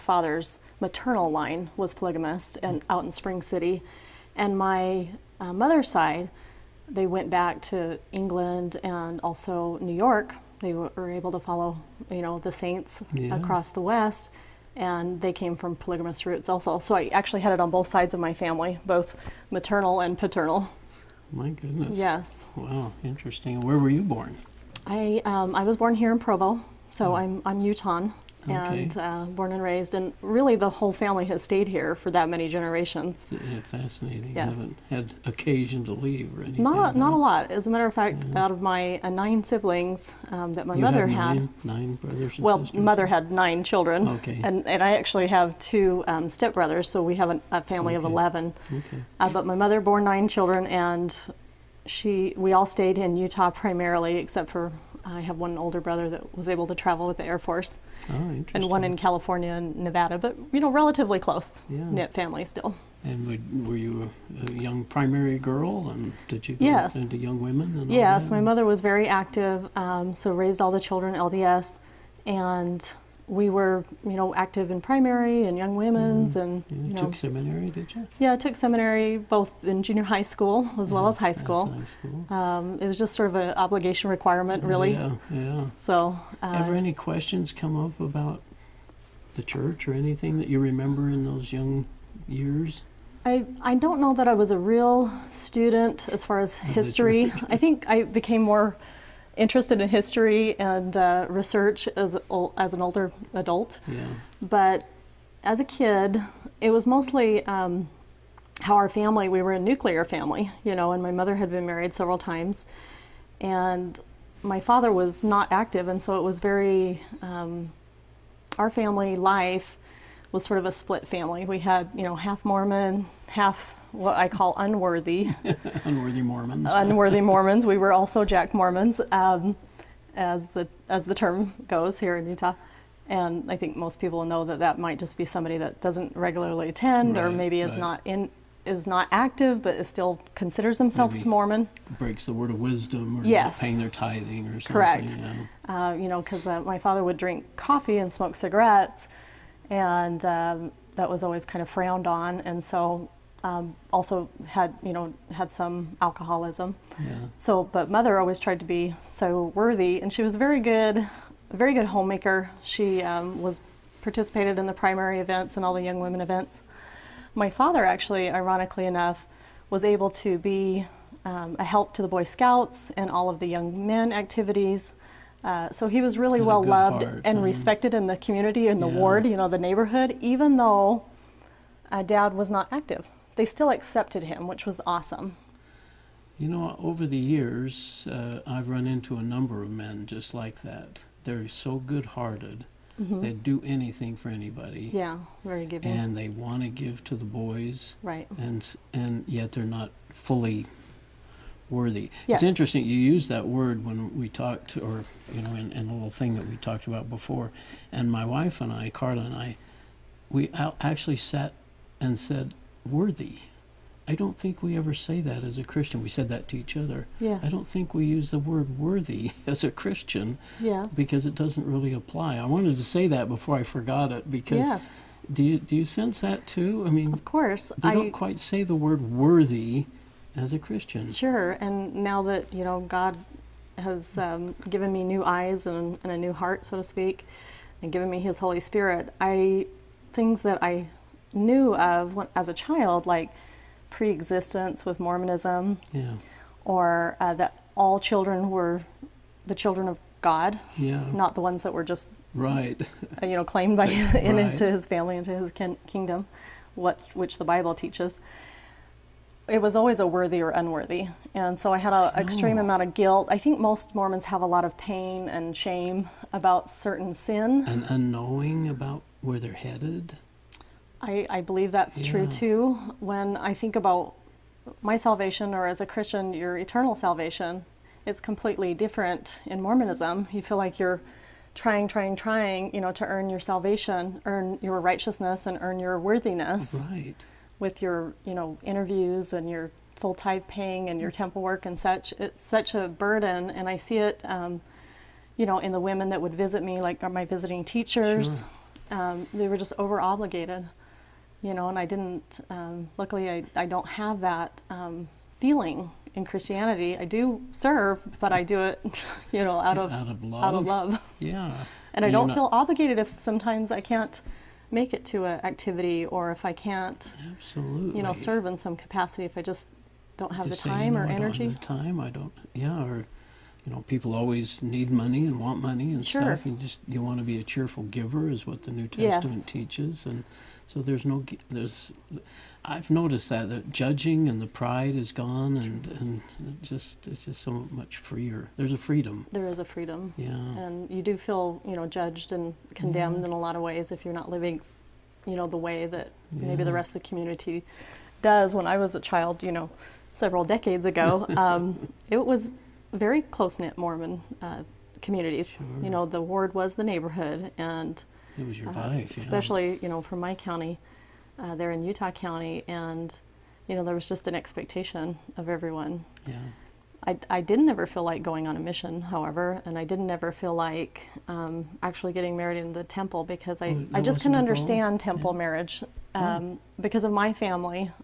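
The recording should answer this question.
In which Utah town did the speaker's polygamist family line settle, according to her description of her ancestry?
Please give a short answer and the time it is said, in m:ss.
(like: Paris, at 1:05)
Spring City, at 0:03.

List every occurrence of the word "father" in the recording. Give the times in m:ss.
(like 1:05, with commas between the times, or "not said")
1:54, 2:26, 2:47.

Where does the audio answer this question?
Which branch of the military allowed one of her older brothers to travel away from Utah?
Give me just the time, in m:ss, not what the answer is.
0:57.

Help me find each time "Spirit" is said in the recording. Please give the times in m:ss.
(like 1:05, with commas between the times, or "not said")
3:58.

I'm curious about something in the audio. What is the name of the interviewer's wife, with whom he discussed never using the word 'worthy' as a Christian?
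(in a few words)
Carla.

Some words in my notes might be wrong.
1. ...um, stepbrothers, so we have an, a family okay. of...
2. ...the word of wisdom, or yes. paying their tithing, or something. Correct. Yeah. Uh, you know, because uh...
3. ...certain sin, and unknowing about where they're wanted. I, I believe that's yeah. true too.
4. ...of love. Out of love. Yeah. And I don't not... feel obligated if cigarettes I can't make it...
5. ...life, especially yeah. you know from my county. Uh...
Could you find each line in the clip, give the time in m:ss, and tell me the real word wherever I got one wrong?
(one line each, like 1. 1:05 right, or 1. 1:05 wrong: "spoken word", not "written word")
1. 0:46 right
2. 2:22 right
3. 4:26 wrong: "headed", not "wanted"
4. 5:10 wrong: "sometimes", not "cigarettes"
5. 5:58 right.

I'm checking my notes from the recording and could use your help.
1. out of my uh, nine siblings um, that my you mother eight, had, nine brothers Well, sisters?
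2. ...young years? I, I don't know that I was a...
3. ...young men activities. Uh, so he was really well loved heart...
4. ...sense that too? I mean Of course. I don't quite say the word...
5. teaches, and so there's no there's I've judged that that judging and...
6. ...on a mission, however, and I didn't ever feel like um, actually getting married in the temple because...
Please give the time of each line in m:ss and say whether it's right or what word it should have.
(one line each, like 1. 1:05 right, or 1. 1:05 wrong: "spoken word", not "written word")
1. 0:38 wrong: "nine", not "eight"
2. 1:31 right
3. 2:53 right
4. 3:45 right
5. 5:29 wrong: "noticed", not "judged"
6. 6:08 right.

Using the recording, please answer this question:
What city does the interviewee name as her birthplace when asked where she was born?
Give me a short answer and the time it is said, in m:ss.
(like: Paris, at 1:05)
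Provo, at 0:26.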